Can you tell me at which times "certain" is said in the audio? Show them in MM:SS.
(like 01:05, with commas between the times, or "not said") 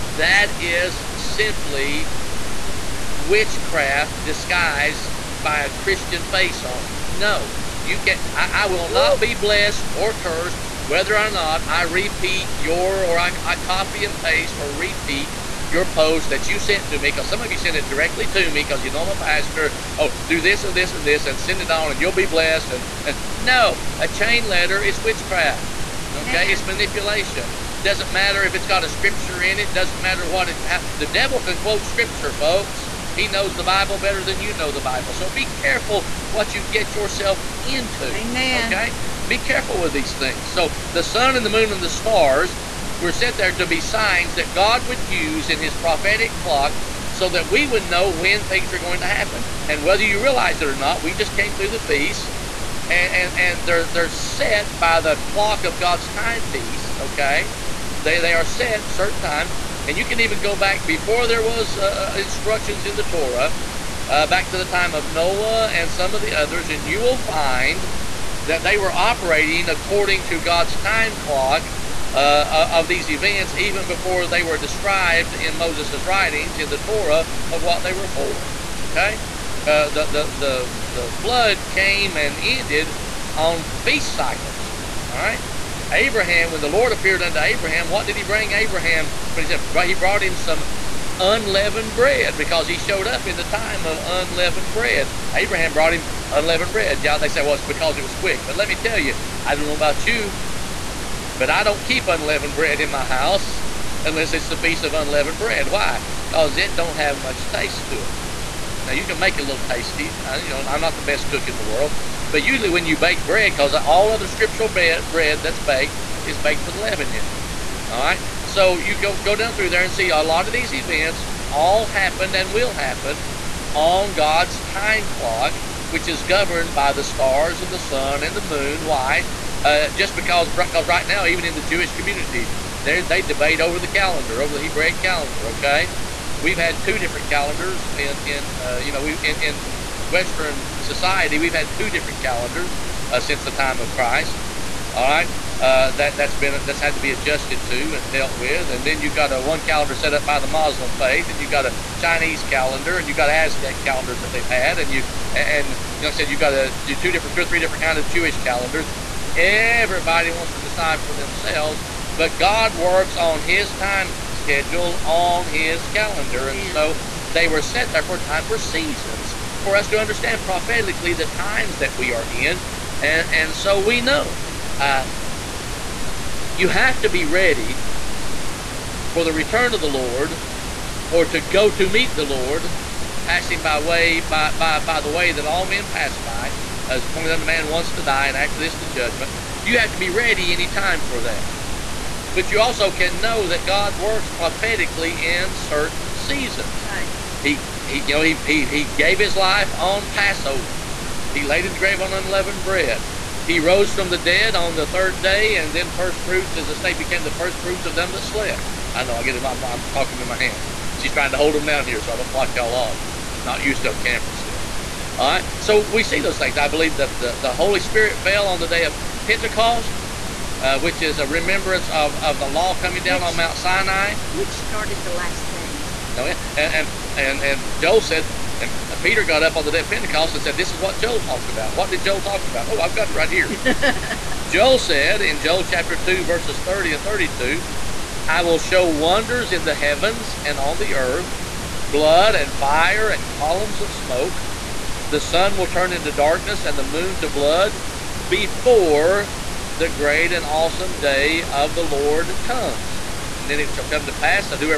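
00:58, 03:15.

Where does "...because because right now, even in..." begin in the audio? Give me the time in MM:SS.
02:10.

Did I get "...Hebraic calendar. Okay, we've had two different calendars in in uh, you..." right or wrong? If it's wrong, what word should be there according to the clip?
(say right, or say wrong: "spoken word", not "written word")
right.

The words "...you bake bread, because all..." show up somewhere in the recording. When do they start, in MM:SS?
01:52.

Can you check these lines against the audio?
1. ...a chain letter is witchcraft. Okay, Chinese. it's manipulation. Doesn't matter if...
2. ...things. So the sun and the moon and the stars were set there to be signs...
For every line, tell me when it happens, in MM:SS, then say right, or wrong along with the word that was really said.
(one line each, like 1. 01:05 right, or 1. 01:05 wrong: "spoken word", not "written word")
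1. 00:23 wrong: "Man", not "Chinese"
2. 00:40 right.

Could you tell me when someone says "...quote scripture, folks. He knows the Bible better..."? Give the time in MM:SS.
00:31.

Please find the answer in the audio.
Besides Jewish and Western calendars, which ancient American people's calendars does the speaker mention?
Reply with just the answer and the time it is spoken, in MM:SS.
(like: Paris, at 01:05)
Aztec, at 02:33.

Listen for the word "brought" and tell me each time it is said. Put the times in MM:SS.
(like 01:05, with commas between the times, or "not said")
01:29, 01:35.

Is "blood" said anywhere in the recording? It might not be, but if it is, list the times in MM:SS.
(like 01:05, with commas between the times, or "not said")
04:01, 04:07.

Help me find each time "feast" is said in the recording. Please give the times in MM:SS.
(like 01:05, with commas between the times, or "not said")
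00:51, 01:23, 01:44.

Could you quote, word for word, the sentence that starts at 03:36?
I believe that the, the Holy Spirit fell on the day of Pentecost.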